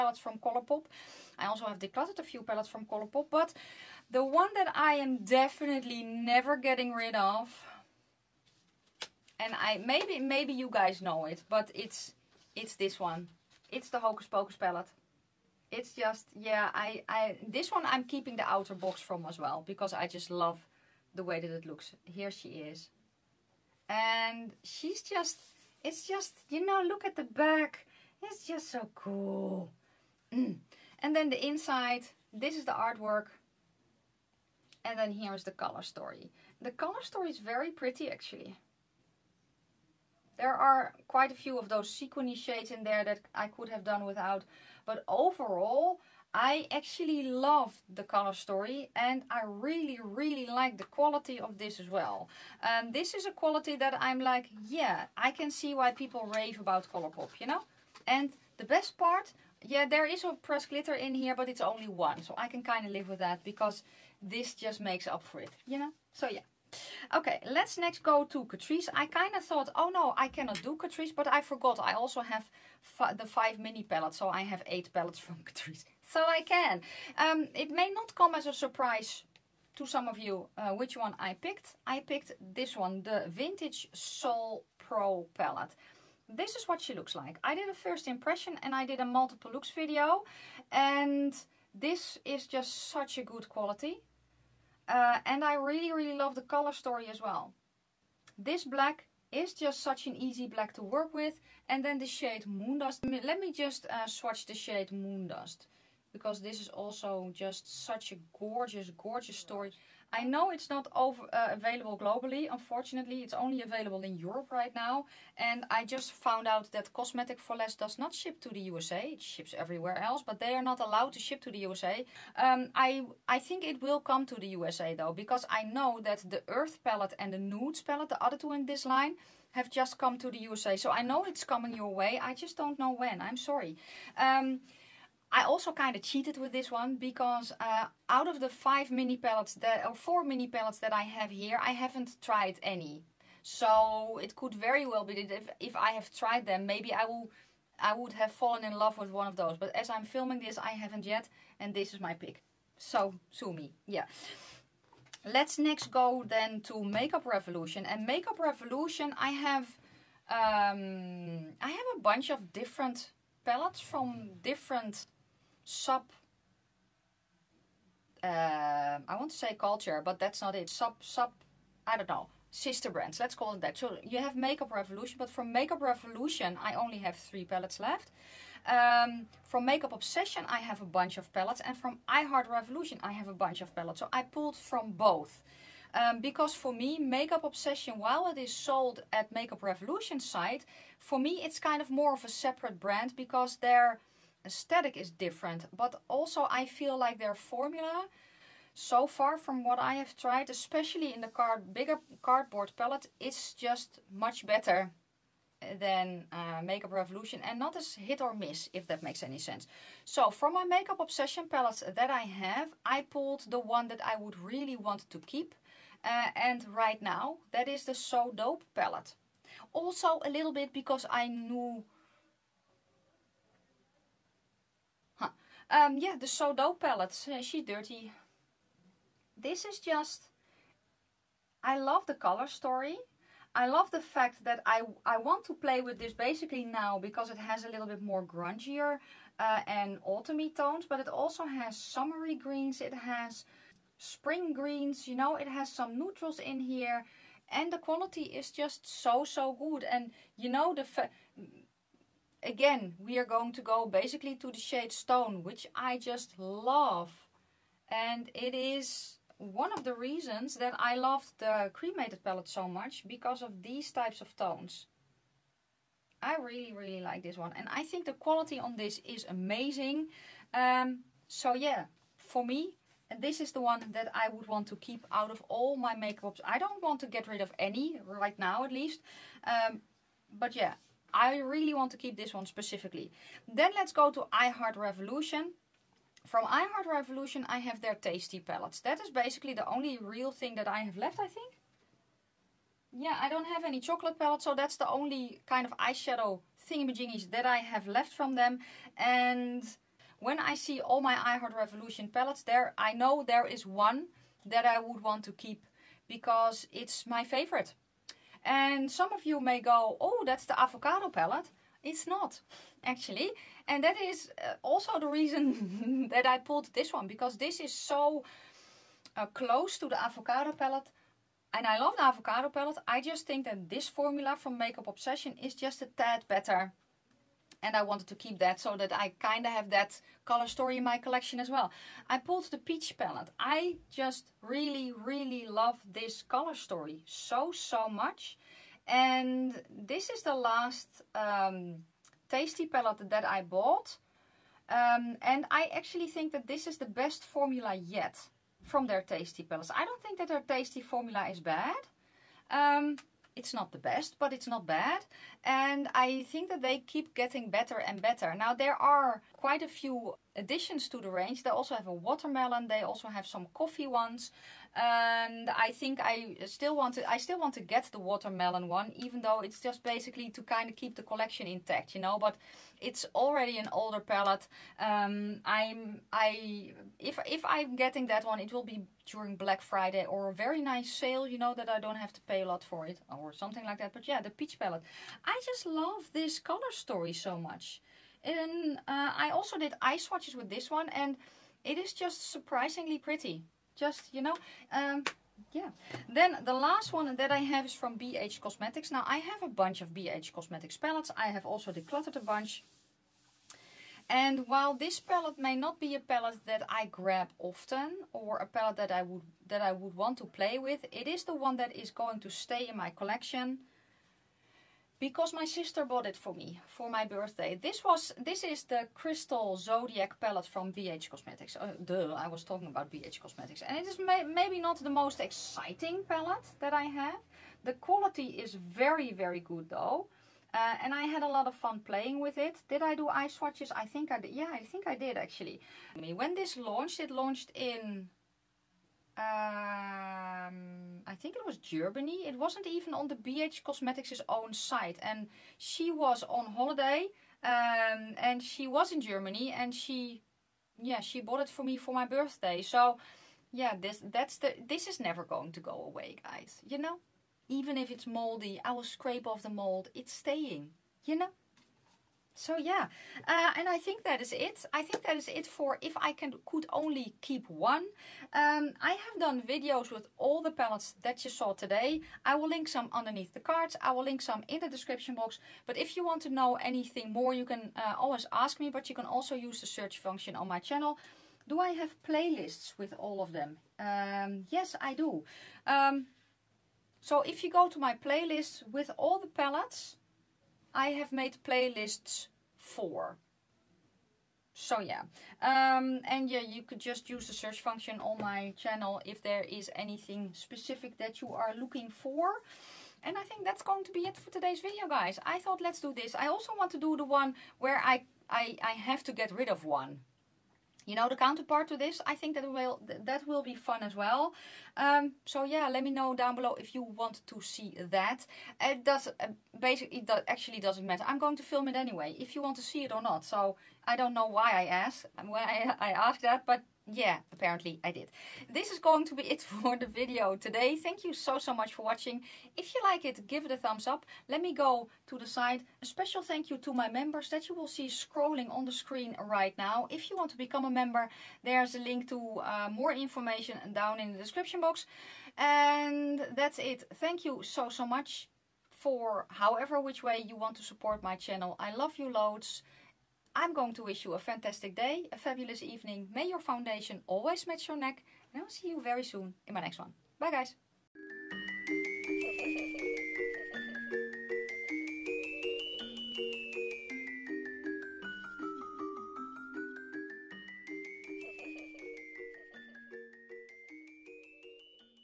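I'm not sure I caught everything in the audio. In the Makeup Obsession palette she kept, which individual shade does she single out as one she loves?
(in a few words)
Stone.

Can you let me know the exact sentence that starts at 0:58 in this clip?
And the best part, yeah, there is a pressed glitter in here, but it's only one.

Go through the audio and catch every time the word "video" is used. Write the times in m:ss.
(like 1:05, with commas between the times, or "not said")
1:29, 7:49, 8:24, 8:49.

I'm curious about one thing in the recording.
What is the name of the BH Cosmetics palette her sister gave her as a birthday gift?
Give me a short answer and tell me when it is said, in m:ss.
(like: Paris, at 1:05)
Crystal Zodiac, at 6:58.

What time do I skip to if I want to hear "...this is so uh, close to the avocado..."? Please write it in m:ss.
5:17.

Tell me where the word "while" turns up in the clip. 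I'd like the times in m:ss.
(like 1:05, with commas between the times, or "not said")
3:08, 6:44.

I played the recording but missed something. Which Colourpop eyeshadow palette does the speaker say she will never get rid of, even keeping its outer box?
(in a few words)
Hocus Pocus.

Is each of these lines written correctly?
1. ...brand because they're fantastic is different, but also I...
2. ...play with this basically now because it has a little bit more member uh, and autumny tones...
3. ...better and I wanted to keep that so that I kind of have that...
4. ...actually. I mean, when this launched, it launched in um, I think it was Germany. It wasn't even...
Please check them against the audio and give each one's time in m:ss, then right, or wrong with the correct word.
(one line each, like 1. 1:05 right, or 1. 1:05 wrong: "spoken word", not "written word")
1. 3:12 wrong: "aesthetic", not "fantastic"
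2. 3:55 wrong: "grungier", not "member"
3. 5:26 right
4. 7:15 right.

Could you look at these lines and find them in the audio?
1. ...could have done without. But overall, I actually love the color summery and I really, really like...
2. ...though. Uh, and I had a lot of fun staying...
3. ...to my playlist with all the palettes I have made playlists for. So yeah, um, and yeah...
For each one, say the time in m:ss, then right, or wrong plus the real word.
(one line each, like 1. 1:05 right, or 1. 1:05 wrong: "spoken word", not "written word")
1. 0:43 wrong: "story", not "summery"
2. 7:09 wrong: "playing", not "staying"
3. 8:07 right.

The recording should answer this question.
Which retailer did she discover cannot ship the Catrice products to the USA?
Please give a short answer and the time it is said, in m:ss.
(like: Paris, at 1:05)
Cosmetic for Less, at 1:56.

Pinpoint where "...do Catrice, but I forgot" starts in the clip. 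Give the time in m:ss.
1:10.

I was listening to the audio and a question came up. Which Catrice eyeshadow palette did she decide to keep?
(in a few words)
Vintage Soul Pro.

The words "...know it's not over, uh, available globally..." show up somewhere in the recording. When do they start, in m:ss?
1:50.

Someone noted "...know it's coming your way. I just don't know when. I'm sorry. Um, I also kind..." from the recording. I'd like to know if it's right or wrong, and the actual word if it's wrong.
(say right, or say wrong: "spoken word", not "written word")
right.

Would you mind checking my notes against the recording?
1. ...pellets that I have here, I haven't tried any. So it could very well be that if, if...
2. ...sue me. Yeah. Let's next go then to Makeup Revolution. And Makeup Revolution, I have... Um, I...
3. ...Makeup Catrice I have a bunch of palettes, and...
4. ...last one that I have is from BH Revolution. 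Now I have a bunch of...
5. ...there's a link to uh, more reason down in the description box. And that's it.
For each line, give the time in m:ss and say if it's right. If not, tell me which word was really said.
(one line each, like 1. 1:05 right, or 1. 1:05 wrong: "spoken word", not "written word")
1. 2:20 right
2. 2:33 right
3. 2:59 wrong: "Obsession", not "Catrice"
4. 6:36 wrong: "Cosmetics", not "Revolution"
5. 9:01 wrong: "information", not "reason".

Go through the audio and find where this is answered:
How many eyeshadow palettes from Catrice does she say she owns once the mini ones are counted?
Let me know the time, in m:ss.
1:14.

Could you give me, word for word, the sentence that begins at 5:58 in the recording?
Now, there are quite a few additions to the range.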